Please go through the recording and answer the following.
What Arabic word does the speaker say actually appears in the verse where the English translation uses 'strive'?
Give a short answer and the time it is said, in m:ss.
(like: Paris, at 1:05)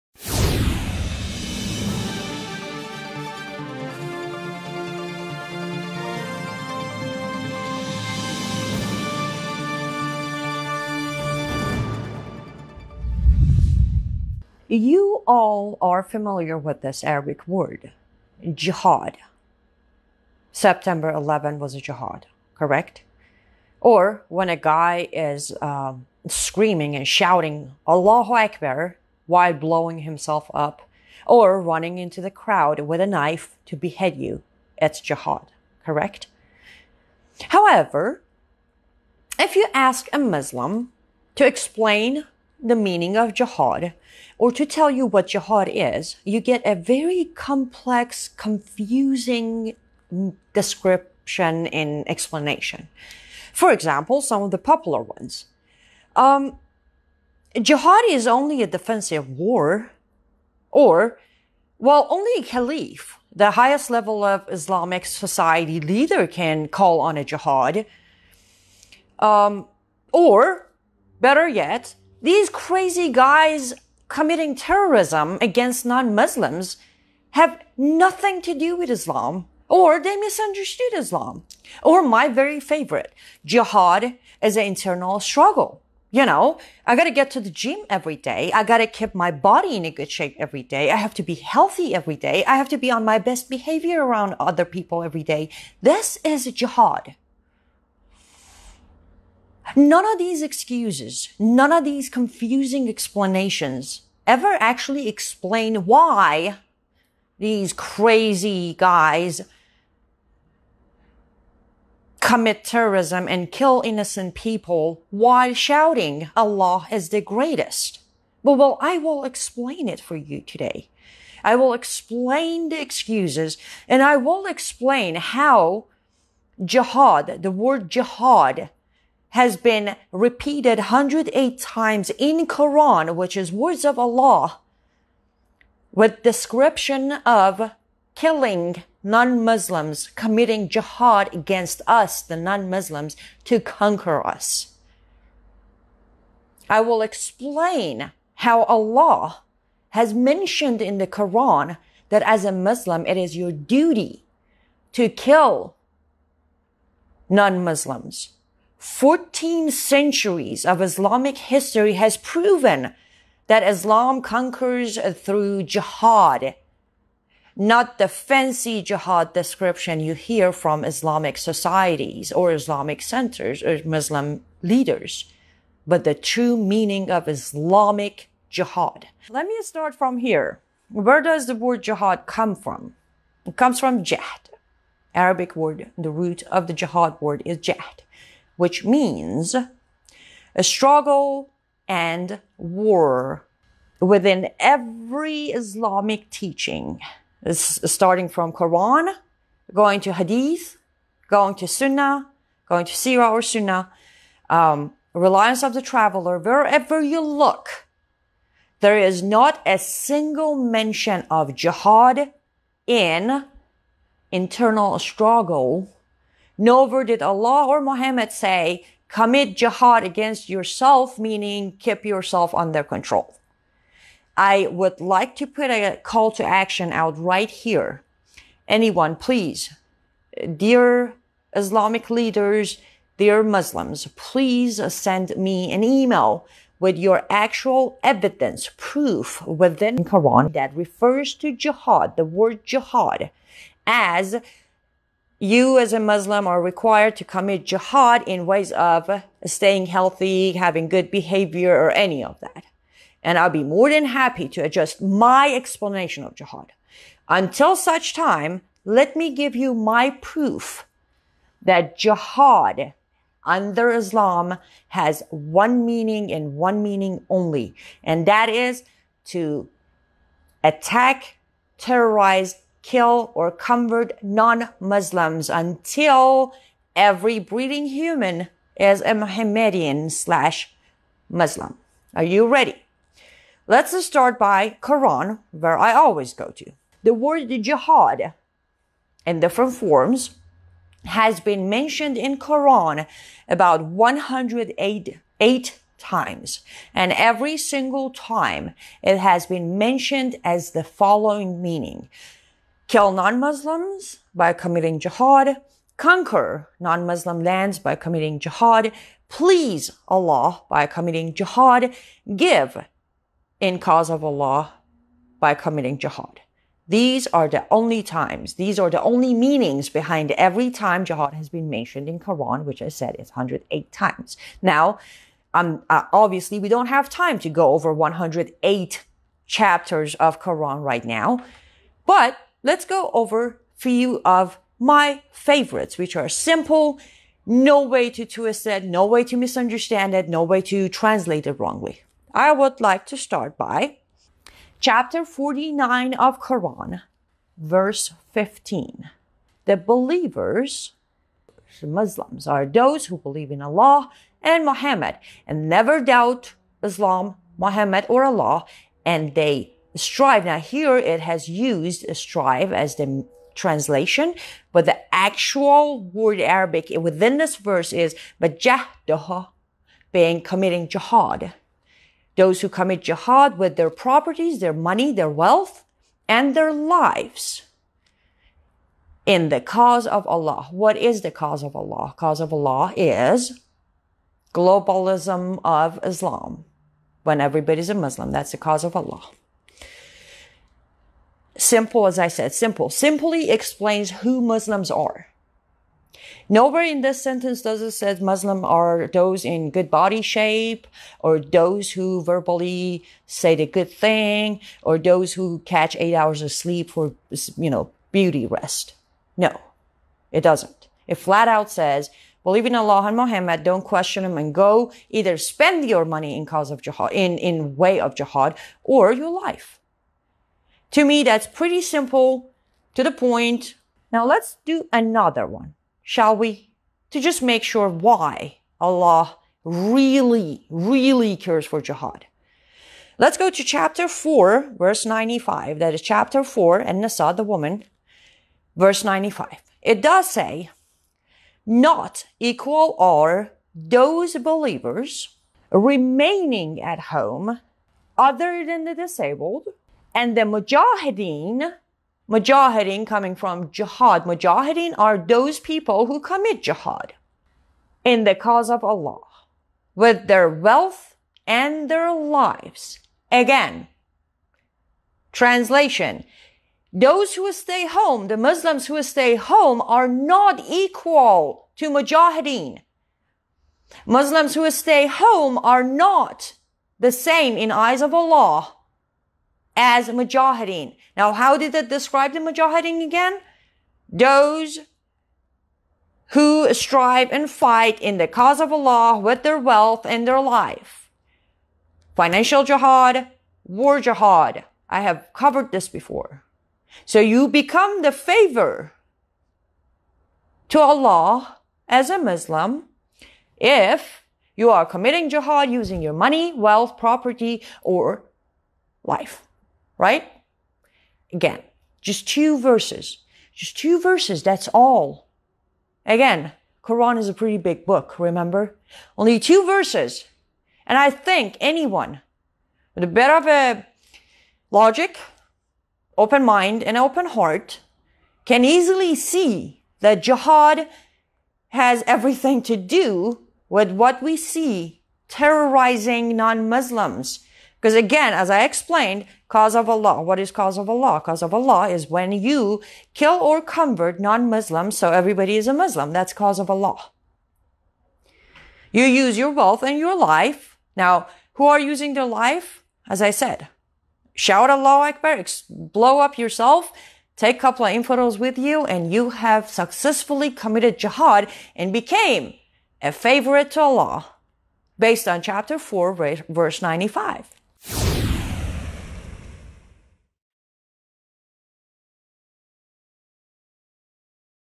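Majahdaha, at 6:08.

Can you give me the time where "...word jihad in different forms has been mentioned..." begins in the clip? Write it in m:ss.
4:47.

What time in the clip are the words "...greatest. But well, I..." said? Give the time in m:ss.
1:57.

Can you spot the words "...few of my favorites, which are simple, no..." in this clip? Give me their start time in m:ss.
5:33.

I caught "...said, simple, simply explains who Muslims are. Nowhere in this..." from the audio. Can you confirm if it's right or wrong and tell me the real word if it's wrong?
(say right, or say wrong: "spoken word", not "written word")
right.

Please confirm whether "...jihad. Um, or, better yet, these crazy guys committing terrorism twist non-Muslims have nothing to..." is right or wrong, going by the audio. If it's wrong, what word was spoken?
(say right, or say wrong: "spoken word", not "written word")
wrong: "against", not "twist".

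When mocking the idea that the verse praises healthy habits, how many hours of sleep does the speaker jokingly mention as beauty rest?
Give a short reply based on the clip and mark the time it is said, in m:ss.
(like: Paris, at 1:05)
8, at 6:45.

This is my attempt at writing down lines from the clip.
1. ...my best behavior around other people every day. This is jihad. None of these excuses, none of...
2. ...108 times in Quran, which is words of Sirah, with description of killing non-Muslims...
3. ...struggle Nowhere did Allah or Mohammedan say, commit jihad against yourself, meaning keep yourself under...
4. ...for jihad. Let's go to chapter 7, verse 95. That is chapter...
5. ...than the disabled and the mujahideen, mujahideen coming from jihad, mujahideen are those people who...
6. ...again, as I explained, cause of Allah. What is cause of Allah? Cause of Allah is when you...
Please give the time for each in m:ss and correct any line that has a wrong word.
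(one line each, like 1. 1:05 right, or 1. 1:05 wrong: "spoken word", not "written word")
1. 1:33 right
2. 2:10 wrong: "Allah", not "Sirah"
3. 3:34 wrong: "Muhammad", not "Mohammedan"
4. 7:11 wrong: "4", not "7"
5. 7:28 right
6. 8:57 right.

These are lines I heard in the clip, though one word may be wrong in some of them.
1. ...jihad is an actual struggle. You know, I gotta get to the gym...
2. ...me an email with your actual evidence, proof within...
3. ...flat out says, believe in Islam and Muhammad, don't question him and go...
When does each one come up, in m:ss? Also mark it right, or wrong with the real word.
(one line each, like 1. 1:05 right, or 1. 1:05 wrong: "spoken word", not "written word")
1. 1:23 wrong: "internal", not "actual"
2. 3:55 right
3. 6:51 wrong: "Allah", not "Islam".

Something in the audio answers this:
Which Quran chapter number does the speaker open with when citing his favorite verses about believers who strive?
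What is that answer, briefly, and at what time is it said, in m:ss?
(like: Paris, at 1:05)
49, at 5:44.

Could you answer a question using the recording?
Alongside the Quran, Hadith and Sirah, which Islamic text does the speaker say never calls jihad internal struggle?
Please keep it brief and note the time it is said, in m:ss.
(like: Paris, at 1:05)
Reliance of the Traveler, at 3:25.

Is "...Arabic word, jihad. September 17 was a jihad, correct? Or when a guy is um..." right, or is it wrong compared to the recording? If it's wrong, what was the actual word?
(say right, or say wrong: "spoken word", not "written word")
wrong: "11", not "17".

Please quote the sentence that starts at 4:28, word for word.
And that is to attack, terrorize, kill or convert non-Muslims until every breathing human is a Mohammedan slash Muslim.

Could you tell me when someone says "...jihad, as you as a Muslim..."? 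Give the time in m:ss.
4:02.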